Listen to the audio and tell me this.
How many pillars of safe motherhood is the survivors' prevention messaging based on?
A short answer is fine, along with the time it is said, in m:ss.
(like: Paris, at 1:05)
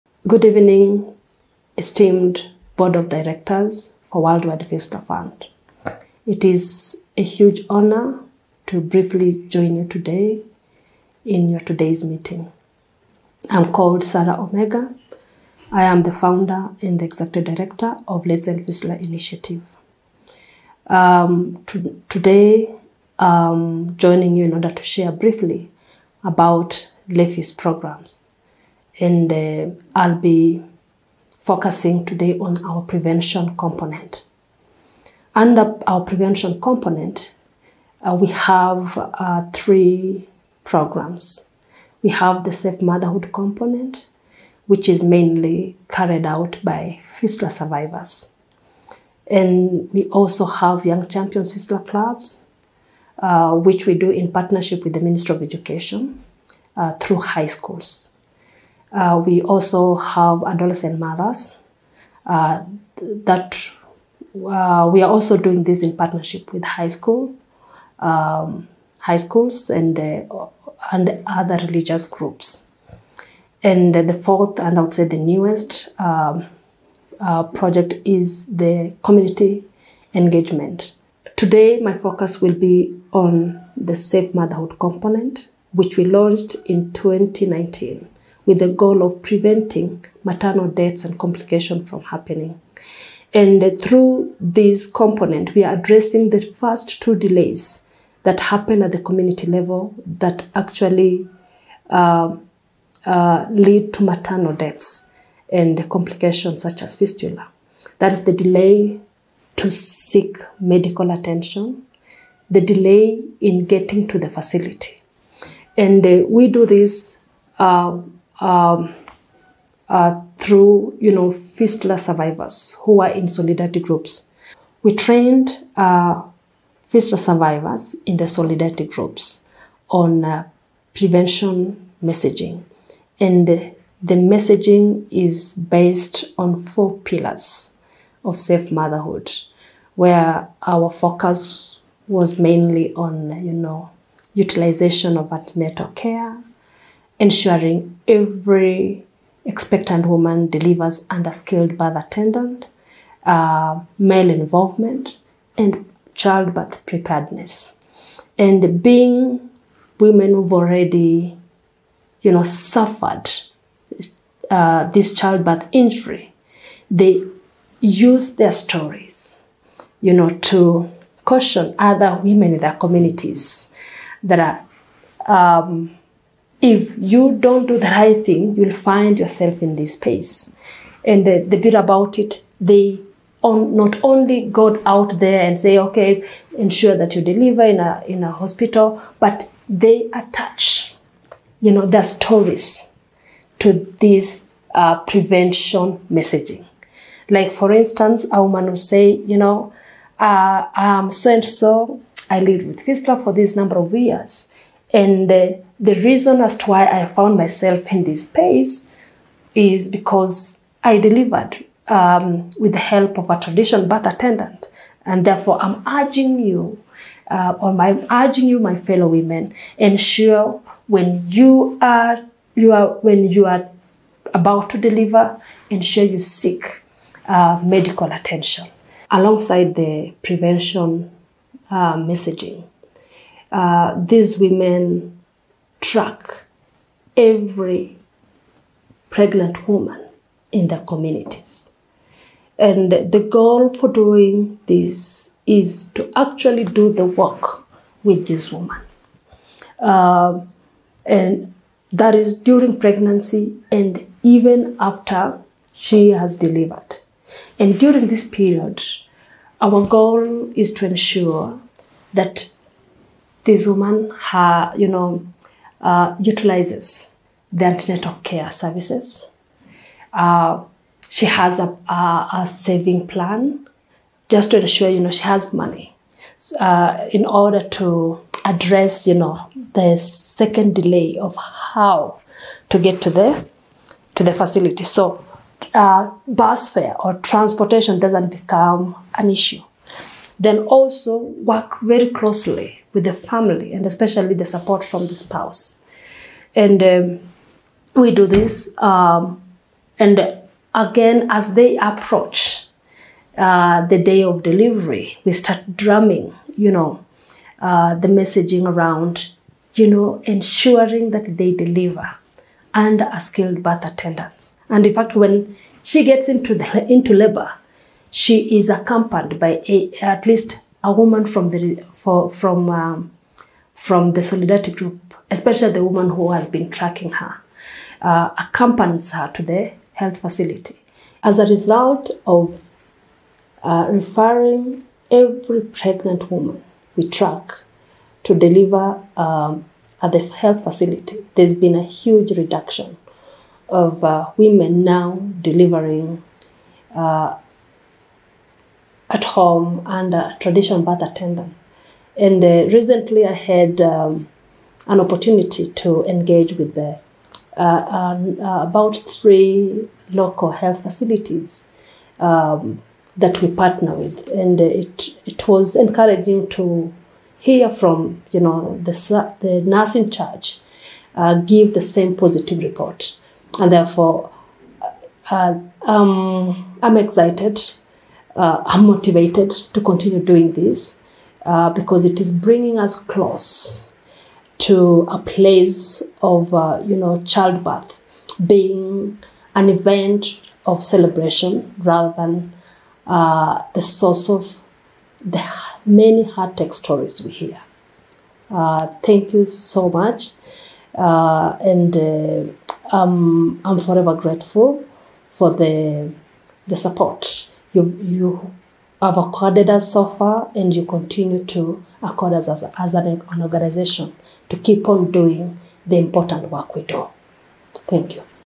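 4, at 2:16.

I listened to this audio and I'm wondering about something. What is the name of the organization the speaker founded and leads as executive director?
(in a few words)
Let's End Fistula Initiative.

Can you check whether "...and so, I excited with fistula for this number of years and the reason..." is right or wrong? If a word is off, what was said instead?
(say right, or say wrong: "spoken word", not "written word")
wrong: "lived", not "excited".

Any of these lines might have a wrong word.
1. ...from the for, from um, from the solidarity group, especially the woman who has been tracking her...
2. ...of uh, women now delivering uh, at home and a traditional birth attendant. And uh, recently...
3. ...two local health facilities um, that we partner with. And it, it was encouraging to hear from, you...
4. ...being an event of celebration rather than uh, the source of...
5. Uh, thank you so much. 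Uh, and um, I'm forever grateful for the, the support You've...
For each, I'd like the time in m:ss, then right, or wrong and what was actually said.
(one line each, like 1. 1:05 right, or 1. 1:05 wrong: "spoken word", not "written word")
1. 5:21 right
2. 5:43 right
3. 5:58 wrong: "three", not "two"
4. 6:28 right
5. 6:38 right.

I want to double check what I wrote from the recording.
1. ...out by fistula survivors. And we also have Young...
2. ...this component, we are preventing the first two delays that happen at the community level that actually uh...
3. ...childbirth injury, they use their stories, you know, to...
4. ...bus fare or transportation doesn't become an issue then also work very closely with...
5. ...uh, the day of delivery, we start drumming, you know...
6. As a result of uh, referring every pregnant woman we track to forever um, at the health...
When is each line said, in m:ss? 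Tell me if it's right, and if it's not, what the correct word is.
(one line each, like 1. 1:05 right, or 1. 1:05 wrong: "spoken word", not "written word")
1. 0:46 right
2. 1:34 wrong: "addressing", not "preventing"
3. 2:45 right
4. 4:46 right
5. 5:03 right
6. 5:31 wrong: "deliver", not "forever".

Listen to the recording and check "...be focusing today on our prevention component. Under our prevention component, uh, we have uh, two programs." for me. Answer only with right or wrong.
wrong.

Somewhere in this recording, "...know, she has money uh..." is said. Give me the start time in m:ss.
4:34.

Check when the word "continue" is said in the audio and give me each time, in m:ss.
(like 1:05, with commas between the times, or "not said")
6:19, 6:50.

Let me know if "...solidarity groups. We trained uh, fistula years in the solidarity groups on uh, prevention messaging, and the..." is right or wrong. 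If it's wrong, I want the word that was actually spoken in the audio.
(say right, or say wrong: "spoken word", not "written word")
wrong: "survivors", not "years".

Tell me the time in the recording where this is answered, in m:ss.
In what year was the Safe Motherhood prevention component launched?
1:26.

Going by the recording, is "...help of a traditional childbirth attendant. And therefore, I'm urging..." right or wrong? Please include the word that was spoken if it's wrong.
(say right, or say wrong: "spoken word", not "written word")
wrong: "birth", not "childbirth".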